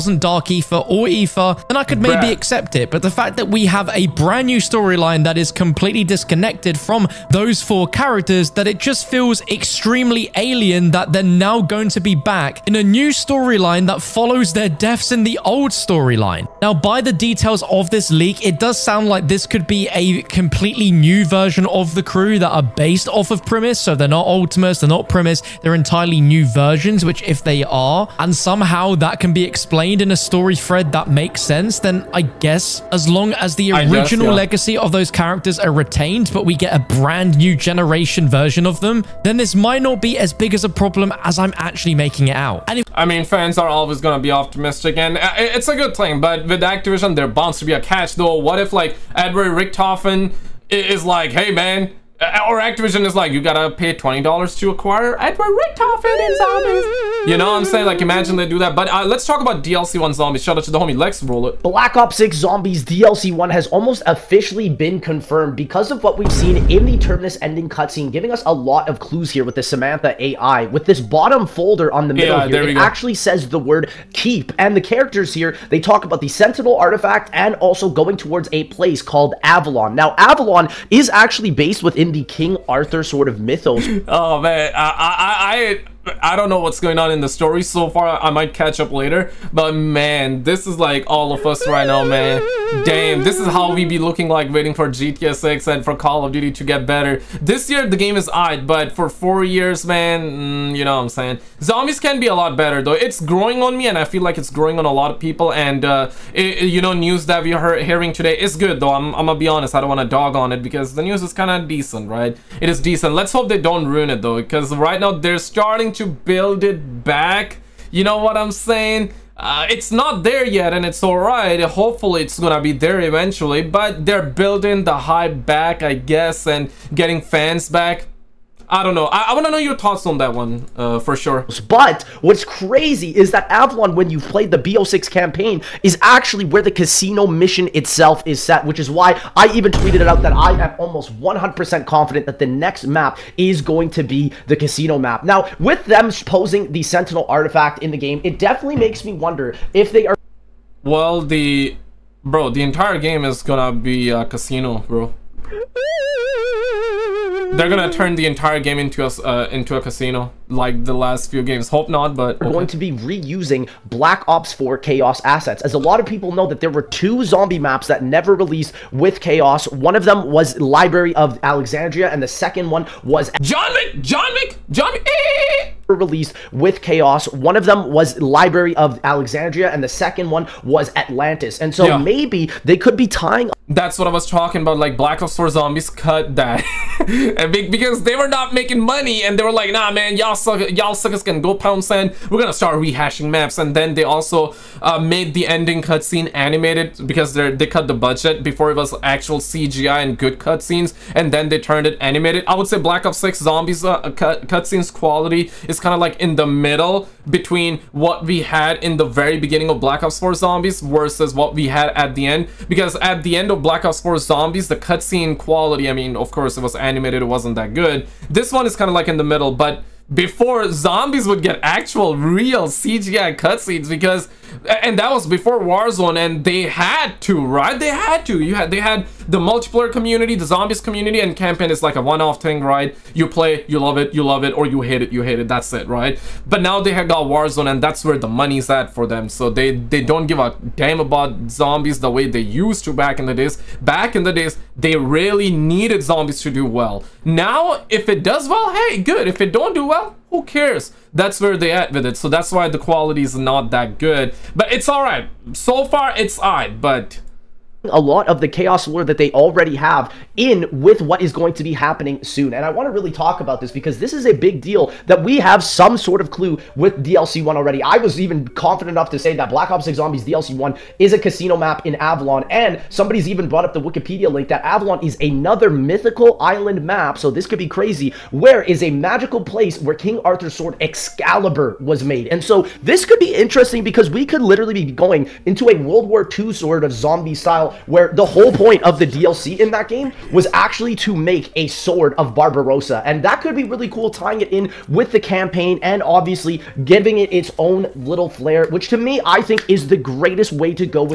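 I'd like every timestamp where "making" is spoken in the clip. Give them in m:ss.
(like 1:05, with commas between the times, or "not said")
0:41, 3:08.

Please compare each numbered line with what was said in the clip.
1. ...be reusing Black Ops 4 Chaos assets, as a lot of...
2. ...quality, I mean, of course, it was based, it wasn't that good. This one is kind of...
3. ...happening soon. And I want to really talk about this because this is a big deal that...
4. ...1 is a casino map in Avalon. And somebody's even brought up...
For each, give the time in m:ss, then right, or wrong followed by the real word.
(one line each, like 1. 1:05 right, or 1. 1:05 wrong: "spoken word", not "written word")
1. 2:42 right
2. 3:35 wrong: "animated", not "based"
3. 4:21 right
4. 4:30 right.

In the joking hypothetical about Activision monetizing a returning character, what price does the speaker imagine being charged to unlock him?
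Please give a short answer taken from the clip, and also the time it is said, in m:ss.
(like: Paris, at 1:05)
$20, at 0:53.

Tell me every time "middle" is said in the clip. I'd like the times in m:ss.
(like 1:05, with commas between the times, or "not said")
1:12, 3:26, 3:39.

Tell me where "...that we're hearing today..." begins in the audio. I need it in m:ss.
1:47.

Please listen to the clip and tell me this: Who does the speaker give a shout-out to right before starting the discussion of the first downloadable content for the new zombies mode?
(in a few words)
Lex Roller.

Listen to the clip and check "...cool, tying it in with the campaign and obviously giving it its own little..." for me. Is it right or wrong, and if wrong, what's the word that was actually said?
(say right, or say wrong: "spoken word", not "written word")
right.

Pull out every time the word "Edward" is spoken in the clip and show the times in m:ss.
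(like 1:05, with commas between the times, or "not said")
0:49, 0:55.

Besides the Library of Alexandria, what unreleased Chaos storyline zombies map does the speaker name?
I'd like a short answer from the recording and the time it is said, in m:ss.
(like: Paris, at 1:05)
Atlantis, at 3:00.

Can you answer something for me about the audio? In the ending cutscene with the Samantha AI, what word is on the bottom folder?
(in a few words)
keep.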